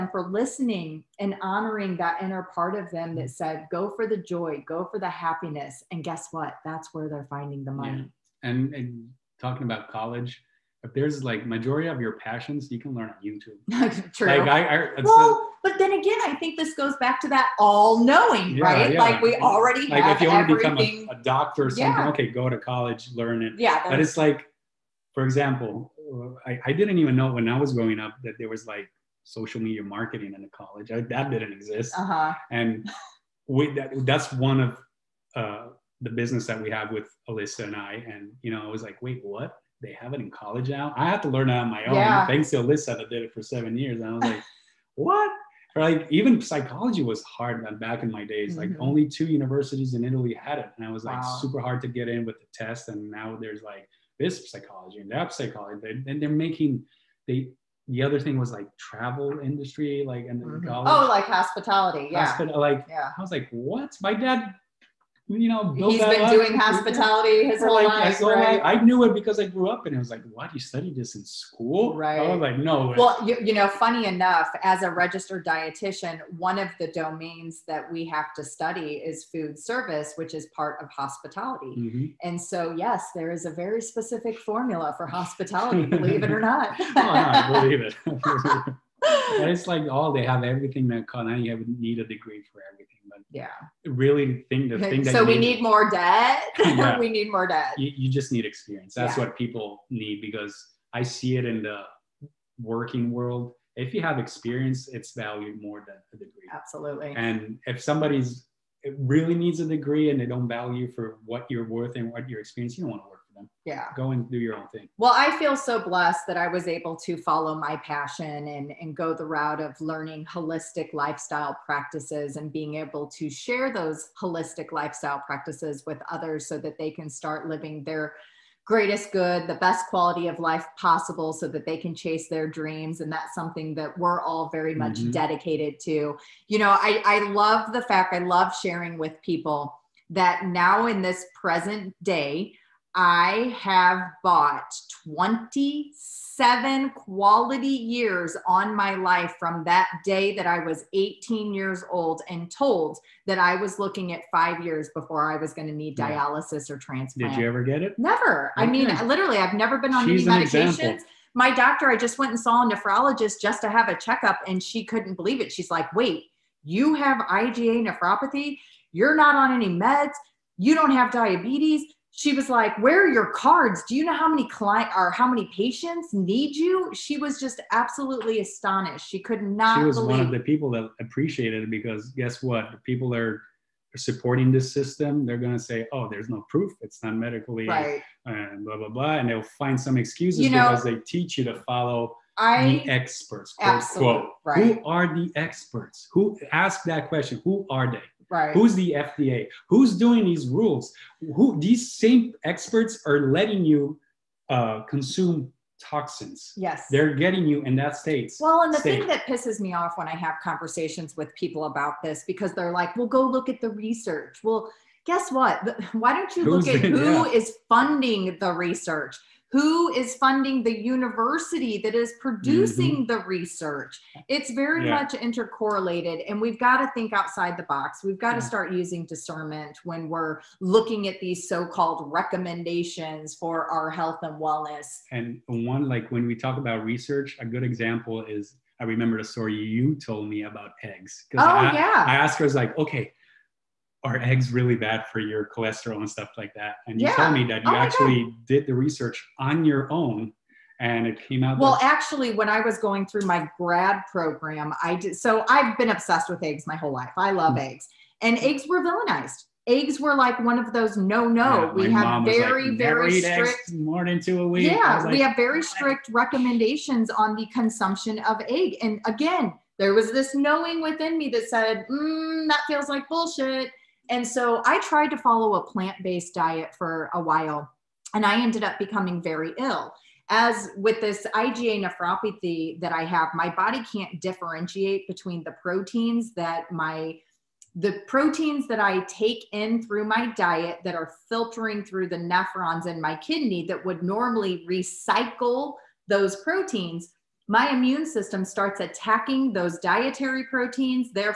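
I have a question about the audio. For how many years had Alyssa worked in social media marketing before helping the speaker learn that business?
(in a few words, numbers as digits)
7.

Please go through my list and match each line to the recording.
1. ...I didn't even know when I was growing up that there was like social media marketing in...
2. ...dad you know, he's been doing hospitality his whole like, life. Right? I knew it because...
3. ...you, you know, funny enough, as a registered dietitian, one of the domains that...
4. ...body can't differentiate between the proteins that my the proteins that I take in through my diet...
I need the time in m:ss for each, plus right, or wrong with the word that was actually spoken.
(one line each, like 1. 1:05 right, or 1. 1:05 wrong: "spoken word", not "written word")
1. 0:26 right
2. 1:04 right
3. 1:13 right
4. 4:43 right.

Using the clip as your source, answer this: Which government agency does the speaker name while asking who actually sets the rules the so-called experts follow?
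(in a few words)
FDA.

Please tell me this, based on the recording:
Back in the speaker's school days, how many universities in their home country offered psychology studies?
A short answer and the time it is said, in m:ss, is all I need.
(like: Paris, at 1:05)
2, at 0:49.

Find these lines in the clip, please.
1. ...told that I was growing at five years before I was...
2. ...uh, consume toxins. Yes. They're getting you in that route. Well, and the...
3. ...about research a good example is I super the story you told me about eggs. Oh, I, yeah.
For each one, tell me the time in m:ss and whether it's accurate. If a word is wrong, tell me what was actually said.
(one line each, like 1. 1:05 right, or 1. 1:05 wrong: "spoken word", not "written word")
1. 2:32 wrong: "looking", not "growing"
2. 3:24 wrong: "state", not "route"
3. 3:56 wrong: "remember", not "super".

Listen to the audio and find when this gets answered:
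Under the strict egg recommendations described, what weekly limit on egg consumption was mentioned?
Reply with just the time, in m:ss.
4:24.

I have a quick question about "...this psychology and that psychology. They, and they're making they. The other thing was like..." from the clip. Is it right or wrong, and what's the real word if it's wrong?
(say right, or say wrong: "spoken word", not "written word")
right.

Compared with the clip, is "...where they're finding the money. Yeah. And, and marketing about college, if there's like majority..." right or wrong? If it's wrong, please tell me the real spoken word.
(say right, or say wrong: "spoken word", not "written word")
wrong: "talking", not "marketing".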